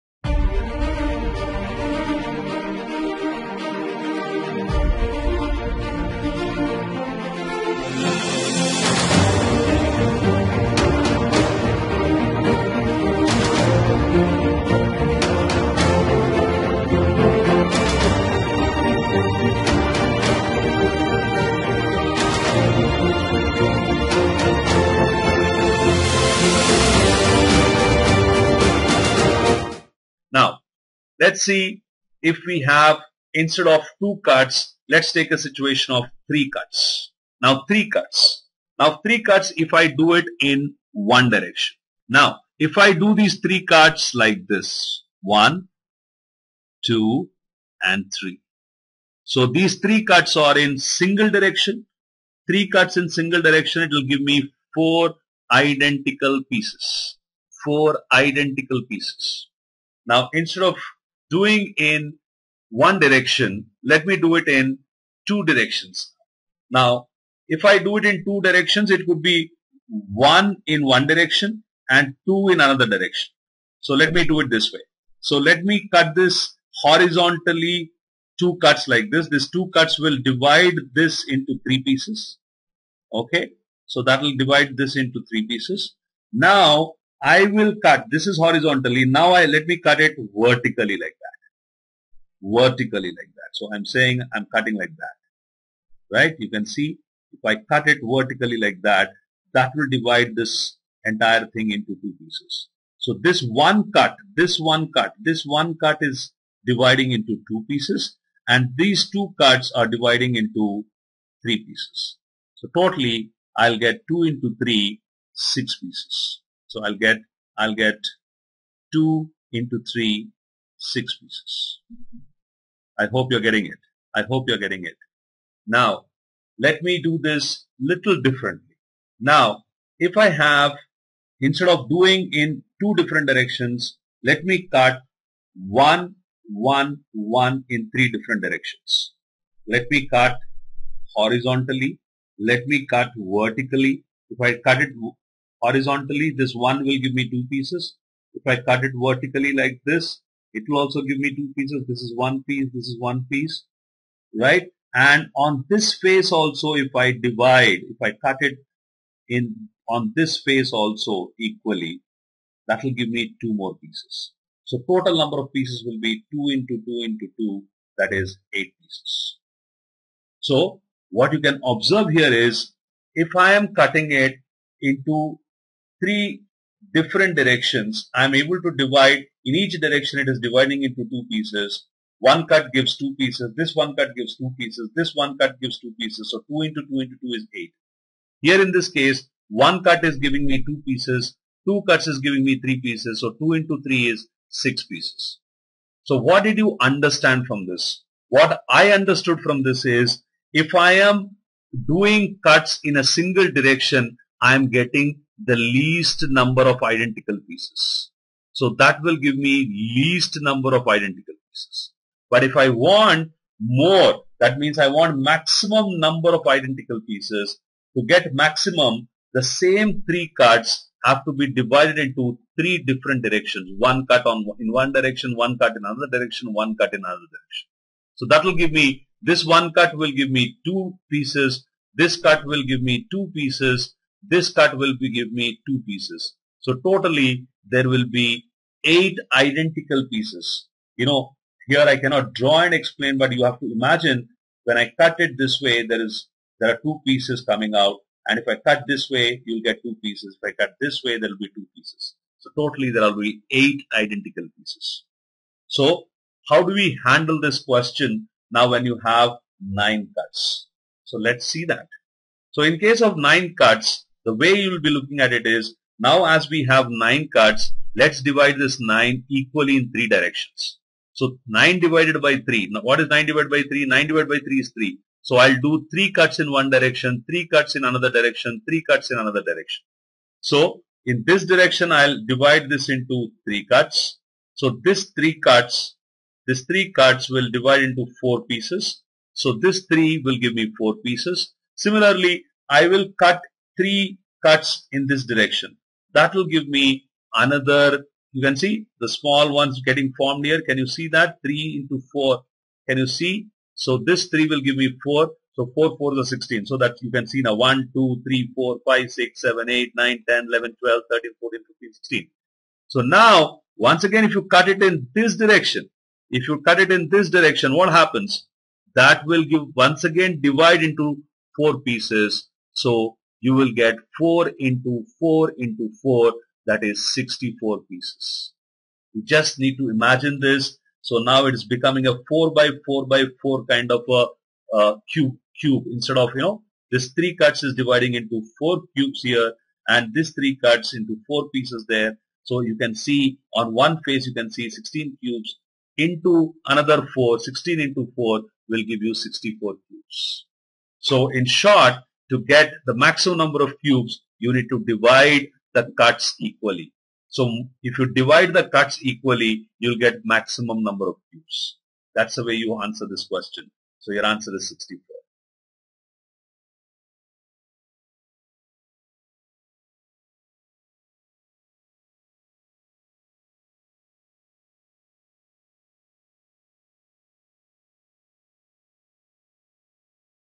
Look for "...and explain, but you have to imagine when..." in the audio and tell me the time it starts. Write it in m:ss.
4:02.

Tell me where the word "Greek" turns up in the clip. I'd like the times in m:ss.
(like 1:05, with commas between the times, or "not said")
not said.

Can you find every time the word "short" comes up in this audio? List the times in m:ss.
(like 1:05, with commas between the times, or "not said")
5:51.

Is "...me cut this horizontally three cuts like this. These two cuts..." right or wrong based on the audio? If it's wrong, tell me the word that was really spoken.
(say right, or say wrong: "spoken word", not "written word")
wrong: "two", not "three".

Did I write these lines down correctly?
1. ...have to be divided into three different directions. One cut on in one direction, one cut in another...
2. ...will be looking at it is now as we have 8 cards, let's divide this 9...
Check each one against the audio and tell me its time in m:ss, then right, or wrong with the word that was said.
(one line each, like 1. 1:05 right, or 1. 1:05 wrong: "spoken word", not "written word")
1. 3:41 right
2. 4:24 wrong: "9", not "8".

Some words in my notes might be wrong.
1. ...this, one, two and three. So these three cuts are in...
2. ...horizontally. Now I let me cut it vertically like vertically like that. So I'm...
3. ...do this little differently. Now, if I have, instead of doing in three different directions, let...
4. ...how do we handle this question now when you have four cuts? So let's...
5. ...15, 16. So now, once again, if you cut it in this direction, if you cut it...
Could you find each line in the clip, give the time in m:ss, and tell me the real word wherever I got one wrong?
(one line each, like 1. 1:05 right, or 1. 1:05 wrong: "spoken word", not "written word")
1. 0:44 right
2. 1:28 right
3. 2:07 wrong: "two", not "three"
4. 4:16 wrong: "nine", not "four"
5. 5:11 right.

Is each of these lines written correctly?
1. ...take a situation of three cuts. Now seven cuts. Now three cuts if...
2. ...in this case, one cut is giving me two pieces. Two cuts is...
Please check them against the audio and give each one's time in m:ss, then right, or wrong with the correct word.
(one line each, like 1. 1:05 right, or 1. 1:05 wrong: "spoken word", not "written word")
1. 0:35 wrong: "three", not "seven"
2. 3:08 right.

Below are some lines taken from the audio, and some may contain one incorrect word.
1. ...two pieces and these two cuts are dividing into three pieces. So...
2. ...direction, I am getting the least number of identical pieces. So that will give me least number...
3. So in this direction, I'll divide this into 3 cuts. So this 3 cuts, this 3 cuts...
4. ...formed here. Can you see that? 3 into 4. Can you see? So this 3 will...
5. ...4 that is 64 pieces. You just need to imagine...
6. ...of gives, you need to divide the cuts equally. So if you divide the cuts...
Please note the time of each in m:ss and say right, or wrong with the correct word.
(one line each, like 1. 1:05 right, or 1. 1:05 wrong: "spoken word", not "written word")
1. 1:47 right
2. 3:23 right
3. 4:40 right
4. 5:00 right
5. 5:26 right
6. 5:53 wrong: "cubes", not "gives".